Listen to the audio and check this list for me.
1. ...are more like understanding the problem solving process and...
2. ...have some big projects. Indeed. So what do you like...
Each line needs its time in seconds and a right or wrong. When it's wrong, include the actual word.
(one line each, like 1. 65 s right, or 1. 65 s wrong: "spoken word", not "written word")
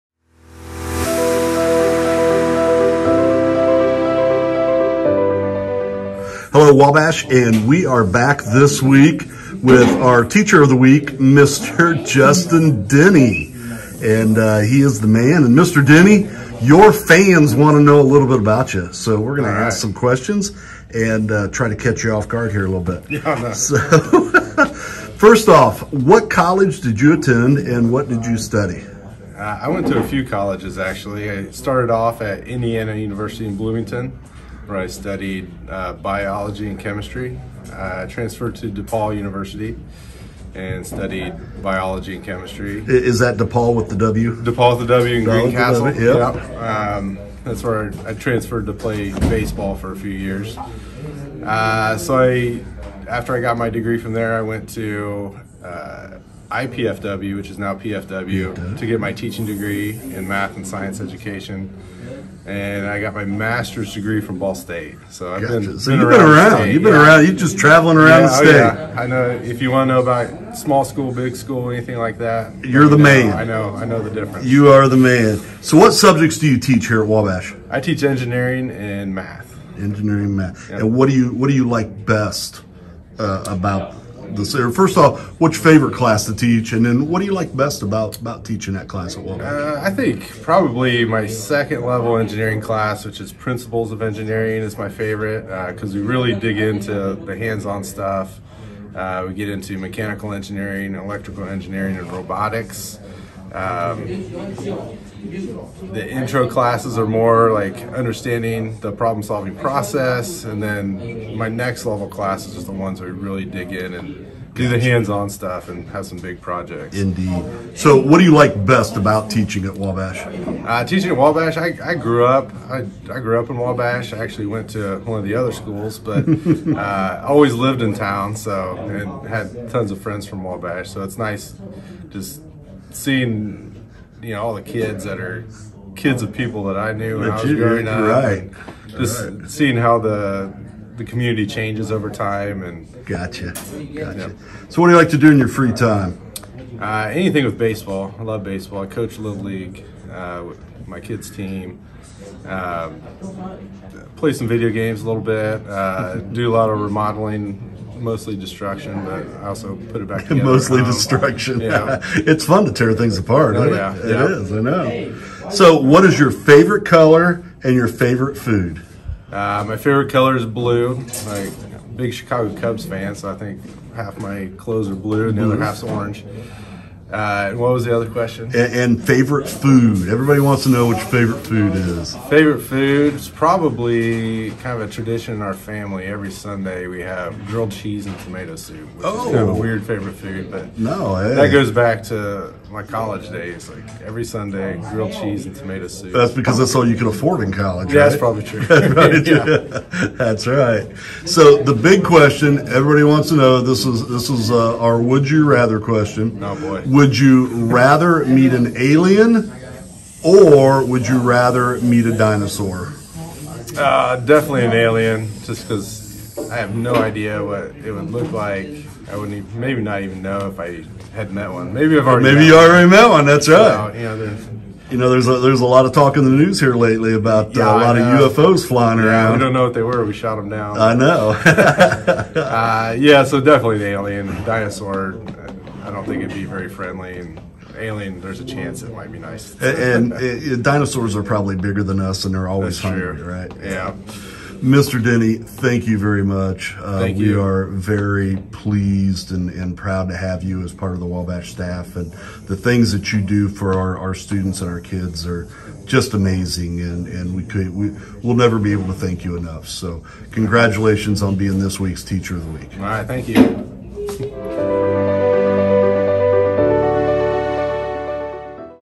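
1. 106 s right
2. 115 s right.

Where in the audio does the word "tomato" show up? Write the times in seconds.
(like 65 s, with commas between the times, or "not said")
188 s, 195 s.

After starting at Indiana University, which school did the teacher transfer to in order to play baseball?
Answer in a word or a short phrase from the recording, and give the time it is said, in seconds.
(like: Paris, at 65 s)
DePauw University, at 38 s.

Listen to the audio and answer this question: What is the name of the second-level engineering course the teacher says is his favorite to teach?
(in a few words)
Principles of Engineering.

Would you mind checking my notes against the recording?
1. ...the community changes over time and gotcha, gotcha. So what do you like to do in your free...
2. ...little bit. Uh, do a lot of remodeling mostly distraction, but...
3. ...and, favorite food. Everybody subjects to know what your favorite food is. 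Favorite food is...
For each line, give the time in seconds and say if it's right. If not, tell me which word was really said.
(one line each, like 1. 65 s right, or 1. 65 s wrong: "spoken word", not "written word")
1. 140 s right
2. 155 s right
3. 178 s wrong: "wants", not "subjects".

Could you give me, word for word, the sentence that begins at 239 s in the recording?
and, and uh, it, dinosaurs are probably bigger than us, and they're always That's hungry, true.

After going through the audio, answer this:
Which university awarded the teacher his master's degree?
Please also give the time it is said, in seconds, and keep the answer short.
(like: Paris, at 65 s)
Ball State, at 64 s.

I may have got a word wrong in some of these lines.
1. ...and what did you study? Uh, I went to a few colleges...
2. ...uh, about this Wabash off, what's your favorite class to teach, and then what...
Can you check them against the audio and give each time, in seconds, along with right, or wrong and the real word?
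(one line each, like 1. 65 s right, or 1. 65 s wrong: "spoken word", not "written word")
1. 27 s right
2. 83 s wrong: "First", not "Wabash".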